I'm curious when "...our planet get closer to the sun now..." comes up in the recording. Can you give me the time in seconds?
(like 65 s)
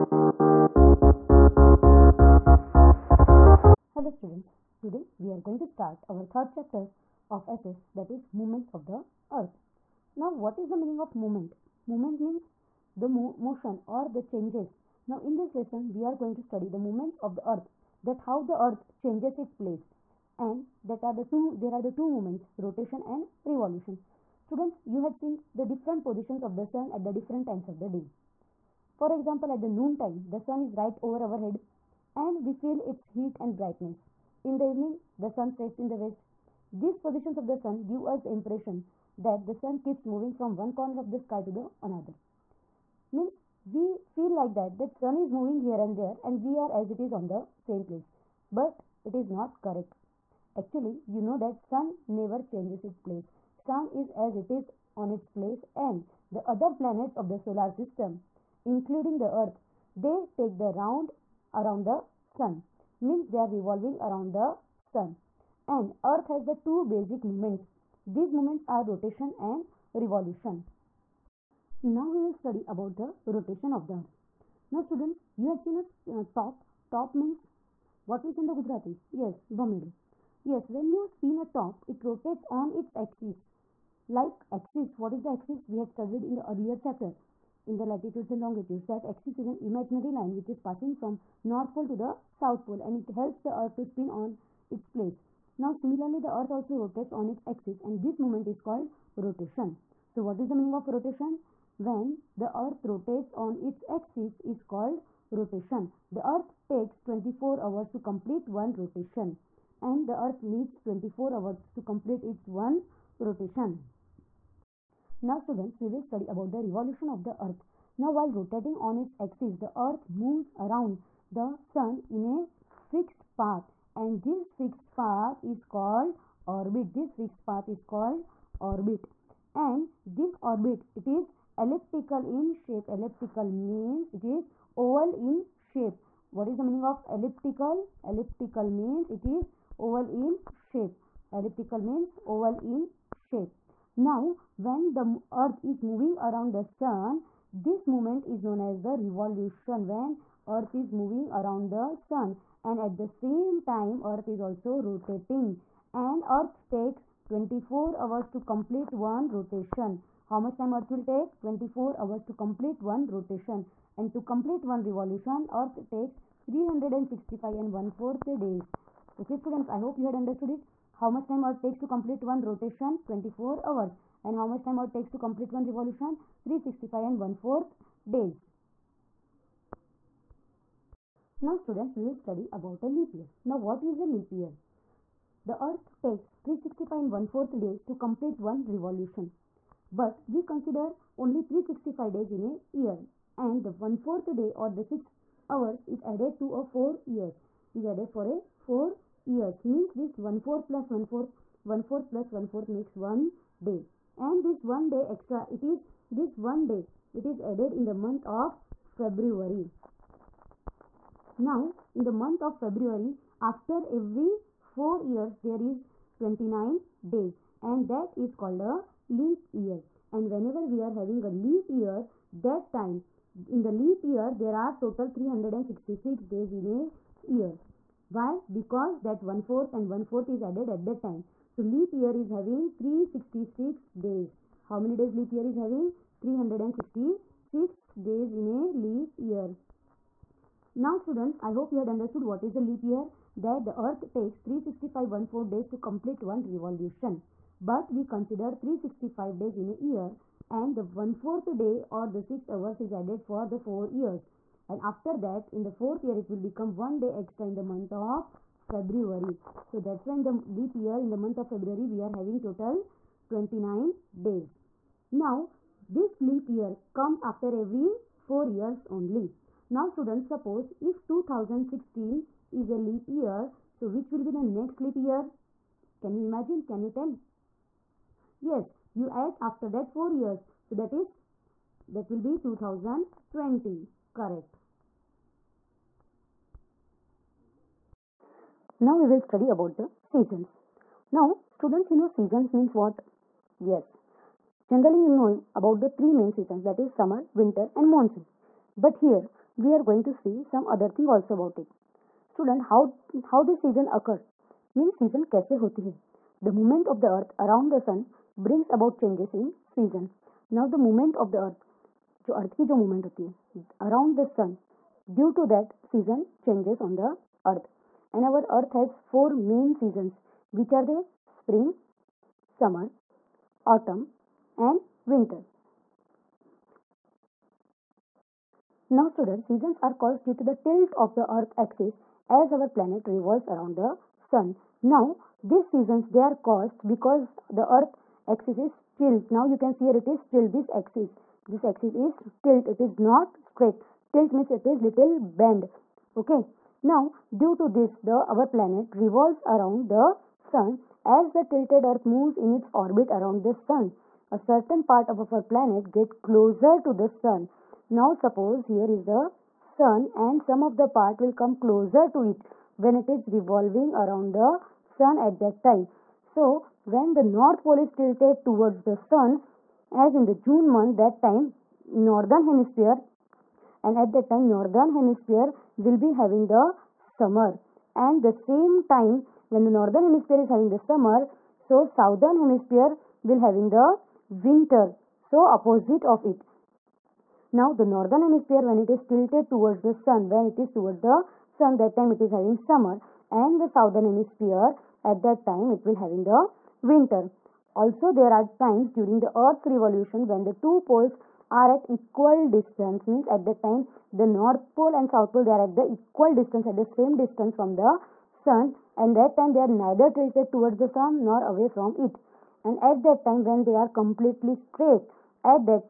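355 s.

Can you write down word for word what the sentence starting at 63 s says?
Means they are revolving around the sun.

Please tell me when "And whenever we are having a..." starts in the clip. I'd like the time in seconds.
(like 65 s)
220 s.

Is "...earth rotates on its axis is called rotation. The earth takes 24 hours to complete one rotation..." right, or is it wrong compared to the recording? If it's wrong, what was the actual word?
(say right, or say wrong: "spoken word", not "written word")
right.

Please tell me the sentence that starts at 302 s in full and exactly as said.
Student, how how this season occur?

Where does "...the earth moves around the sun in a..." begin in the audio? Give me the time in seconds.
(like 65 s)
119 s.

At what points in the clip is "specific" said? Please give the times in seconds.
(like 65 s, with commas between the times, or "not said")
not said.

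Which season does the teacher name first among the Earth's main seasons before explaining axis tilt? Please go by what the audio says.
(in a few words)
Spring.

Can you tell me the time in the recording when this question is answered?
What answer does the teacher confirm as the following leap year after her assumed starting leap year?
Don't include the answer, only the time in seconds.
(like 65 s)
282 s.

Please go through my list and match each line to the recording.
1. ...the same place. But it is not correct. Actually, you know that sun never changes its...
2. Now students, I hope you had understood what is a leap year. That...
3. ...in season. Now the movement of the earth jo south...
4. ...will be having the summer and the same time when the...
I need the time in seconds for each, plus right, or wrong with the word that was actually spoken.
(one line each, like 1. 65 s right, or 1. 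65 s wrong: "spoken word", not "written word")
1. 47 s right
2. 240 s right
3. 309 s wrong: "earth", not "south"
4. 375 s right.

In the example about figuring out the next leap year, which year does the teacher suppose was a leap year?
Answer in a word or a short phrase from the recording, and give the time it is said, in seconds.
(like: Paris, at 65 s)
2016, at 271 s.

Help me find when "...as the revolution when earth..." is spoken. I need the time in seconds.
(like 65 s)
148 s.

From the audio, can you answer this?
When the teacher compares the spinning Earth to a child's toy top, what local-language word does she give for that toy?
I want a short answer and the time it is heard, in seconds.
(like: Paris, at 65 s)
Bamidu, at 79 s.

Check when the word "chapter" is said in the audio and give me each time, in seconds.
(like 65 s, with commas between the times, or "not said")
6 s, 86 s.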